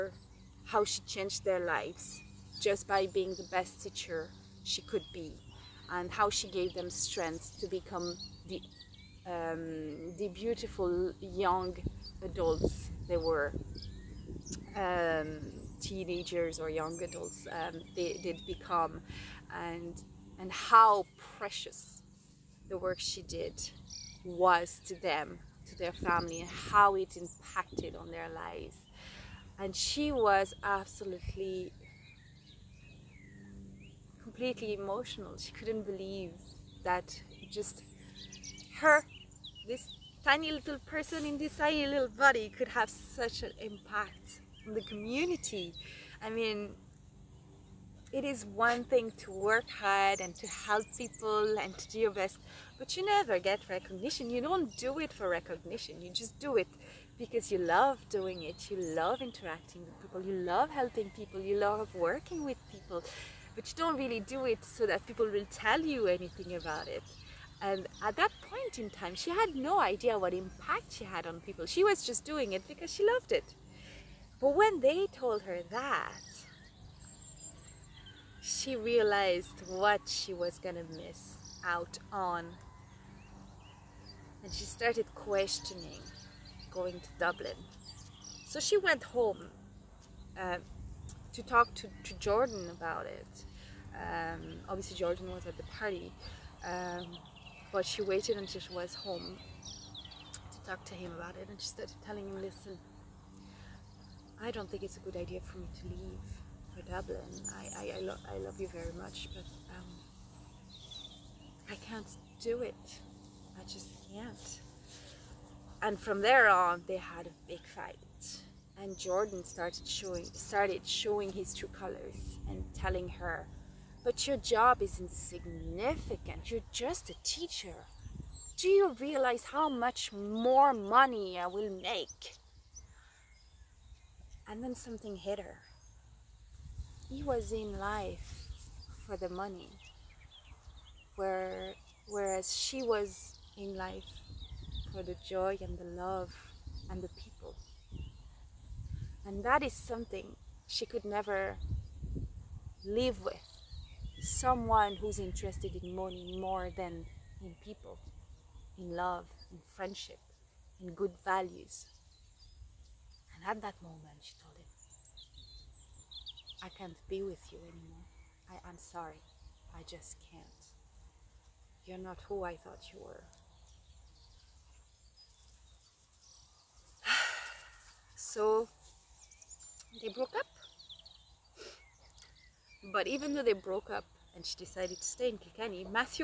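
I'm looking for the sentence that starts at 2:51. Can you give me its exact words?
You're not who I thought you were.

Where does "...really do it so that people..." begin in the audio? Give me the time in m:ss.
1:03.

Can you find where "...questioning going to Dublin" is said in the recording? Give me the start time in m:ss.
1:25.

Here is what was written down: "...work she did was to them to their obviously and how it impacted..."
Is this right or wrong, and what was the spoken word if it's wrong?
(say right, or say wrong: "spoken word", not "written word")
wrong: "family", not "obviously".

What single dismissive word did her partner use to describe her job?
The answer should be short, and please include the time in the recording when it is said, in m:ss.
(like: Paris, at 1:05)
insignificant, at 2:05.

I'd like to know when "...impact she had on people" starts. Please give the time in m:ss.
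1:10.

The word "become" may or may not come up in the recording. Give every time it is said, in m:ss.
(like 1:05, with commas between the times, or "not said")
0:07, 0:18.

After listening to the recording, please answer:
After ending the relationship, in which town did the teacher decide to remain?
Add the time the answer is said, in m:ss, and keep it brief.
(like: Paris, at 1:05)
Kilkenny, at 3:05.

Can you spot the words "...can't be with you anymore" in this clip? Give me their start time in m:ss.
2:46.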